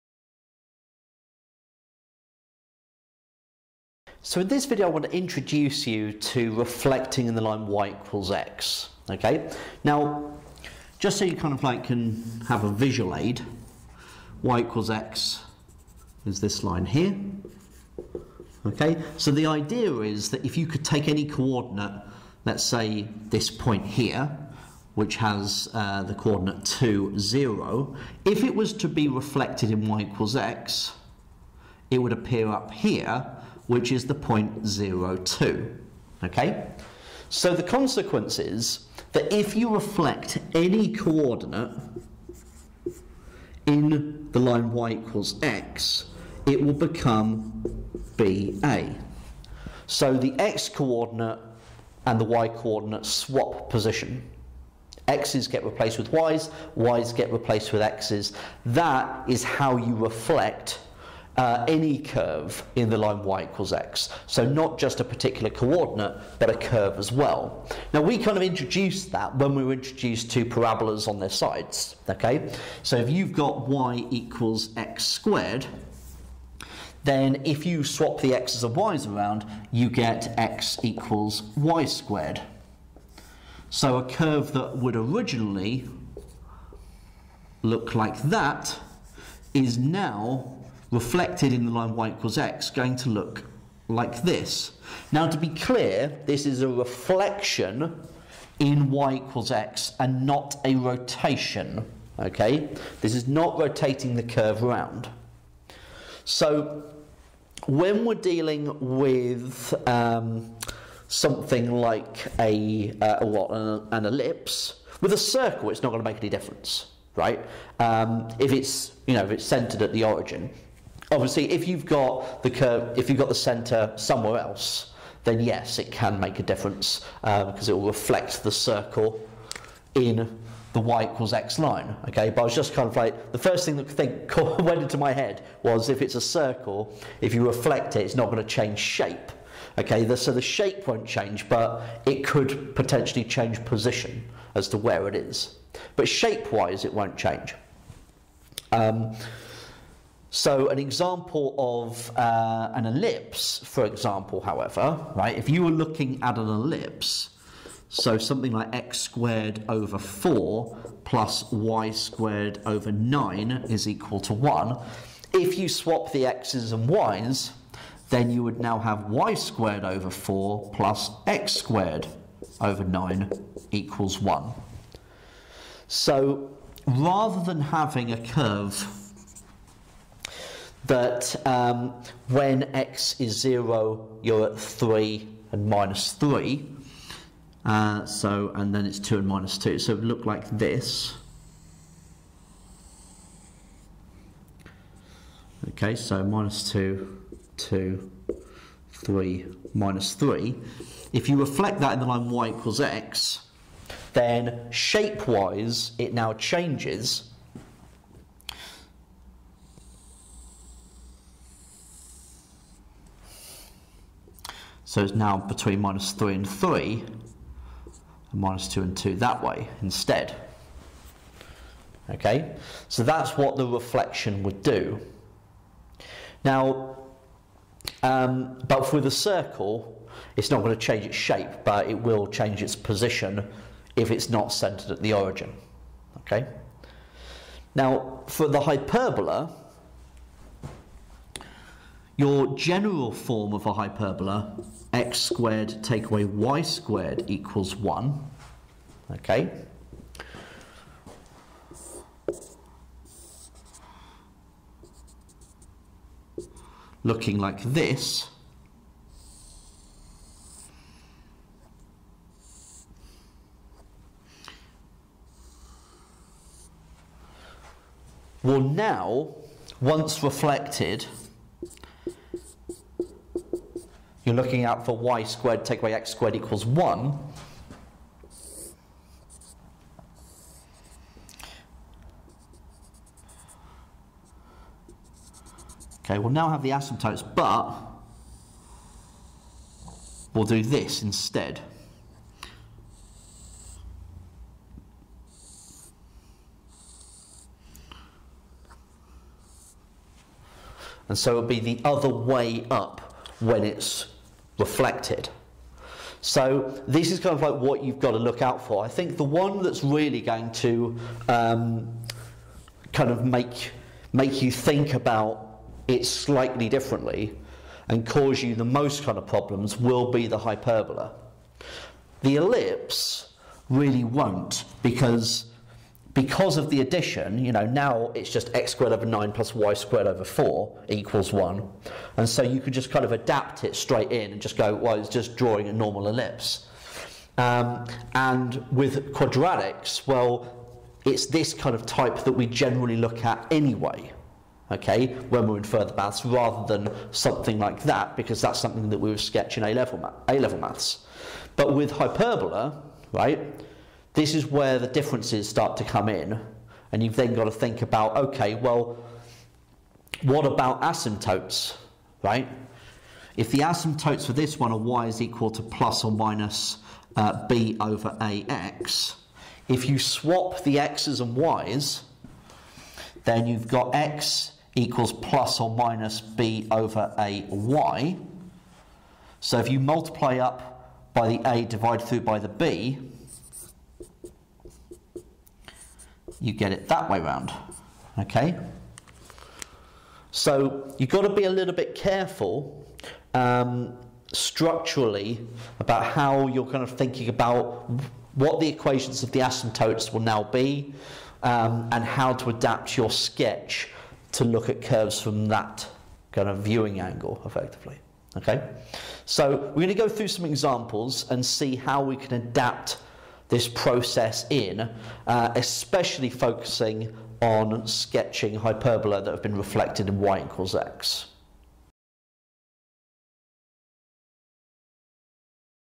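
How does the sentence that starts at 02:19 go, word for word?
Okay, the, so the shape won't change, but it could potentially change position as to where it is.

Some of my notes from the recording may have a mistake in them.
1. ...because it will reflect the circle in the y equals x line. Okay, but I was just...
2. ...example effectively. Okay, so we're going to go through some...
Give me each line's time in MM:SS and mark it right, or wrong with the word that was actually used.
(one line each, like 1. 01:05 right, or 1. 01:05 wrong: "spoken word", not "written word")
1. 02:07 right
2. 06:47 wrong: "angle", not "example".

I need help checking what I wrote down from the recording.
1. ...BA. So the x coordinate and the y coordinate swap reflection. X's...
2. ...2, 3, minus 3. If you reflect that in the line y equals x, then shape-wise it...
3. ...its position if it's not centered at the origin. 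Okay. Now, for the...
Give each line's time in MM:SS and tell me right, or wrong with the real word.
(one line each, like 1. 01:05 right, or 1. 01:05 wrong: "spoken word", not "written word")
1. 00:48 wrong: "position", not "reflection"
2. 03:17 right
3. 03:52 right.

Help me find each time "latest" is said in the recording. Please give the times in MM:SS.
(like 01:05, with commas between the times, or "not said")
not said.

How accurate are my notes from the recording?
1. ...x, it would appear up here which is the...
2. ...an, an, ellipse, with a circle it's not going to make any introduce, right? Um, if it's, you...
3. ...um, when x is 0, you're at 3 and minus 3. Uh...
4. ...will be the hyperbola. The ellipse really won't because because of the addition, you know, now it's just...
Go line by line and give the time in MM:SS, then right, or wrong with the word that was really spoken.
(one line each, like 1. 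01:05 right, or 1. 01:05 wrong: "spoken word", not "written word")
1. 00:30 right
2. 01:53 wrong: "difference", not "introduce"
3. 03:01 right
4. 05:19 right.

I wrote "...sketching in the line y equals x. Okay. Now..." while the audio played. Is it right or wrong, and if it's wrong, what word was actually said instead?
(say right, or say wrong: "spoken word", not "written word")
wrong: "reflecting", not "sketching".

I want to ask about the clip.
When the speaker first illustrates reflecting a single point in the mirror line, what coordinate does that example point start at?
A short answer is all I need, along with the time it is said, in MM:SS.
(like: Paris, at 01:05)
(2, 0), at 00:26.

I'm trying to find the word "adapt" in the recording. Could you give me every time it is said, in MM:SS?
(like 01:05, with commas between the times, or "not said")
05:33, 06:42, 06:52.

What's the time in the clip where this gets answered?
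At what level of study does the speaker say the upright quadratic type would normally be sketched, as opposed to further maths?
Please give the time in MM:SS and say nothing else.
05:50.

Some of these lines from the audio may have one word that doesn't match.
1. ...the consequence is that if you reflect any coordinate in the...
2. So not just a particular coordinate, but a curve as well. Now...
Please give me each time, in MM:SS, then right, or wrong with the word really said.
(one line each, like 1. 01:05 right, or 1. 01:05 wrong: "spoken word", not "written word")
1. 00:37 right
2. 01:04 right.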